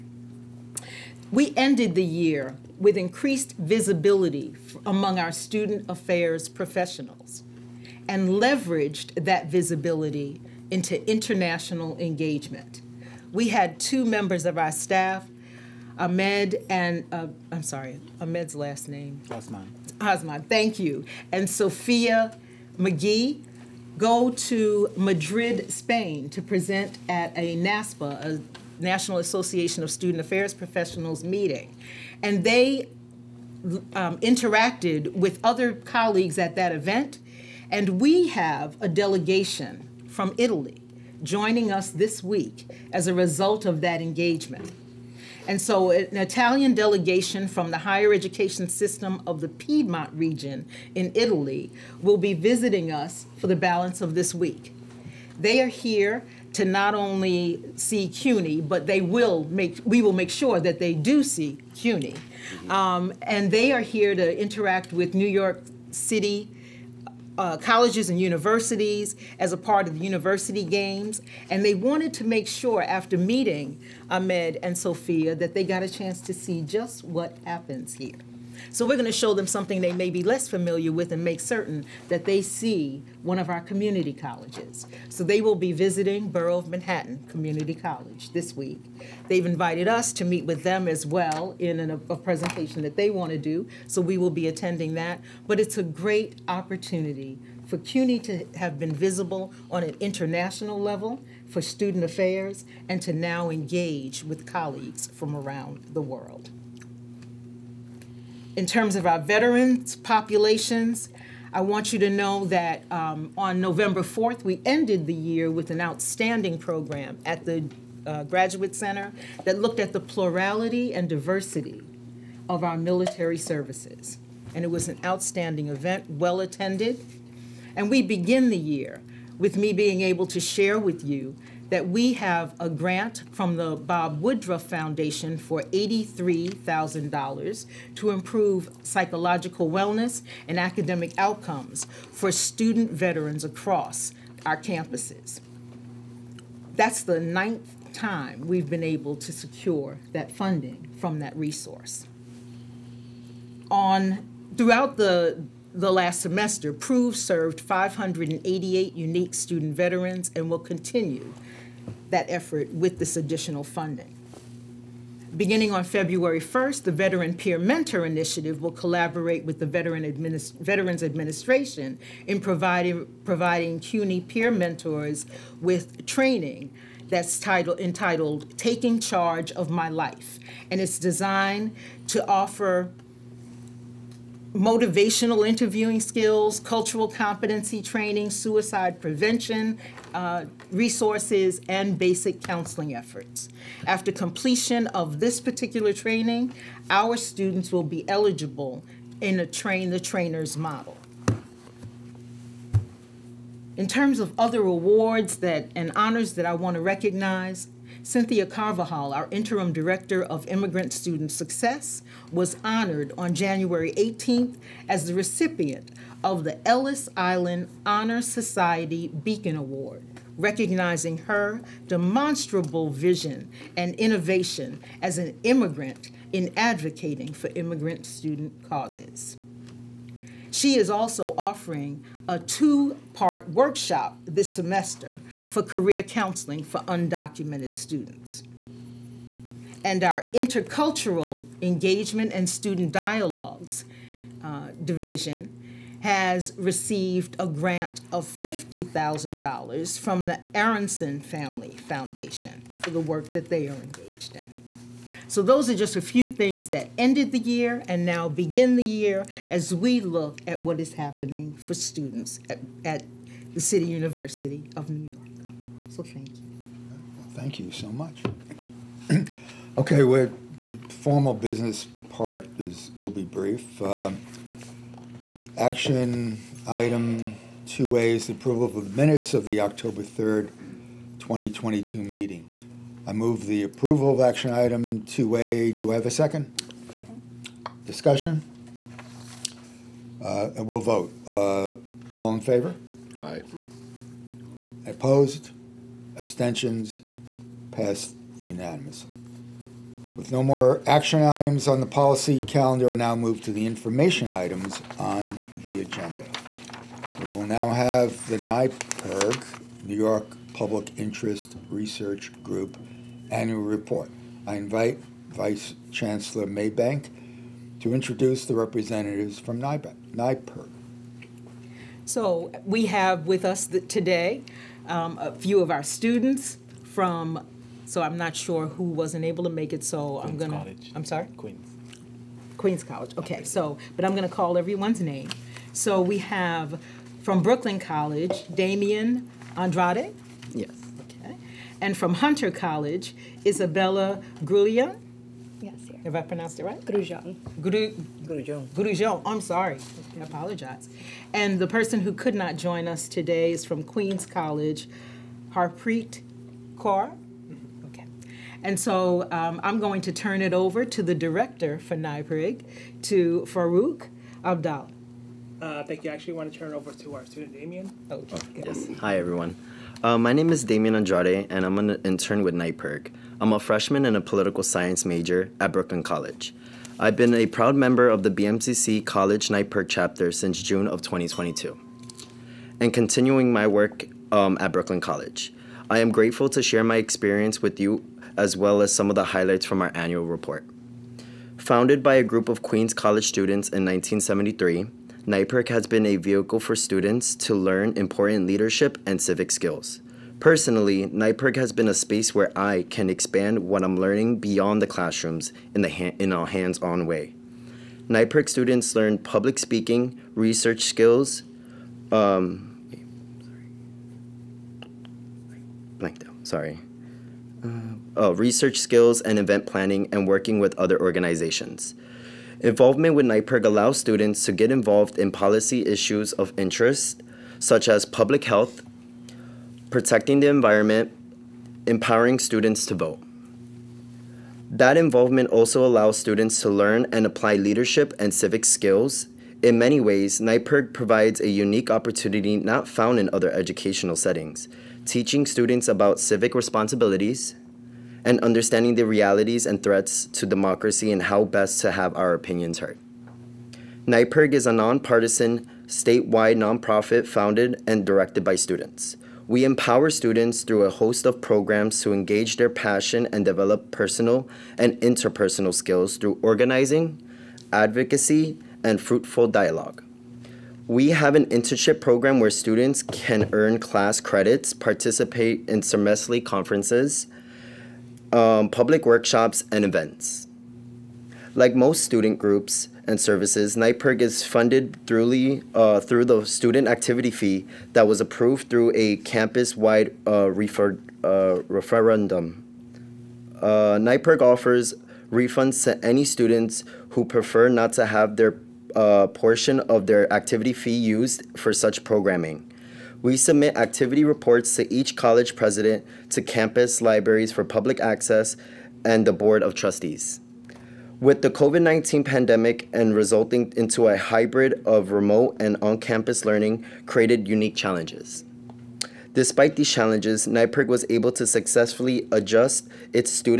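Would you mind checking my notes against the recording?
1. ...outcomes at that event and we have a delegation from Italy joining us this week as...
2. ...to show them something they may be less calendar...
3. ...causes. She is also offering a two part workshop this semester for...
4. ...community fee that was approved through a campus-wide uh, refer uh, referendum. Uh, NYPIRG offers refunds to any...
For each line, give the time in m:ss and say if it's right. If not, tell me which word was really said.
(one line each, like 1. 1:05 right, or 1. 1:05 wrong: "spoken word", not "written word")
1. 0:35 wrong: "colleagues", not "outcomes"
2. 1:19 wrong: "familiar", not "calendar"
3. 3:48 right
4. 8:06 wrong: "activity", not "community".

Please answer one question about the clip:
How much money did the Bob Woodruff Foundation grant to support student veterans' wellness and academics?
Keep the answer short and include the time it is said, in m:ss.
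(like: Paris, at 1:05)
$83,000, at 2:15.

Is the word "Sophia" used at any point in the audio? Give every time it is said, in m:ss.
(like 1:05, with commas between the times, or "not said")
0:21, 1:14.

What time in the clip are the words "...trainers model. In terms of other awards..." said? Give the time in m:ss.
3:19.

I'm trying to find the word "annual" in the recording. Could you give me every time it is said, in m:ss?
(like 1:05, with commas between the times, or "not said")
5:13, 6:29.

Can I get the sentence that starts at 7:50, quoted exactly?
We have an internship program where students can earn class credits, participate in semesterly conferences, um, public workshops, and events.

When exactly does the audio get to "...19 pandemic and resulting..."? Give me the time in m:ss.
8:31.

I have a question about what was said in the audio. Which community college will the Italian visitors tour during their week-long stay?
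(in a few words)
Borough of Manhattan Community College.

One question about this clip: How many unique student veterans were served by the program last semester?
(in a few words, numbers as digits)
588.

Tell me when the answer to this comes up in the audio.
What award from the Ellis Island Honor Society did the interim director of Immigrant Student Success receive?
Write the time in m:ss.
3:39.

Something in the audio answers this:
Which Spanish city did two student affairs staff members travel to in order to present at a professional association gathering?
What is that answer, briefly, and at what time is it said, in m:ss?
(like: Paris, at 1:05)
Madrid, at 0:24.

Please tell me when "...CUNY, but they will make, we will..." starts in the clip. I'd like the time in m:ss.
0:58.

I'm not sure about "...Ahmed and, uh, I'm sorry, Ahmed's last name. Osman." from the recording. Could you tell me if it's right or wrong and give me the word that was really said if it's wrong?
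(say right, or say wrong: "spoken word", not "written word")
right.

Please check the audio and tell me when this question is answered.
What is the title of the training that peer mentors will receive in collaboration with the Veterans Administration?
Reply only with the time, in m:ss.
2:58.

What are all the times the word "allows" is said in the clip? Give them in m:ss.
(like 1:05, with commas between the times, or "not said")
7:03, 7:15.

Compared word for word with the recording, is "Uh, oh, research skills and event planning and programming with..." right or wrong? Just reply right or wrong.
wrong.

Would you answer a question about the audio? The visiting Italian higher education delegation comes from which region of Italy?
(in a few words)
Piedmont.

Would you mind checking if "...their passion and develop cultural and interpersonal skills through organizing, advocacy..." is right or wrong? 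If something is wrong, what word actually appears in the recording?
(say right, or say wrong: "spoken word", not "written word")
wrong: "personal", not "cultural".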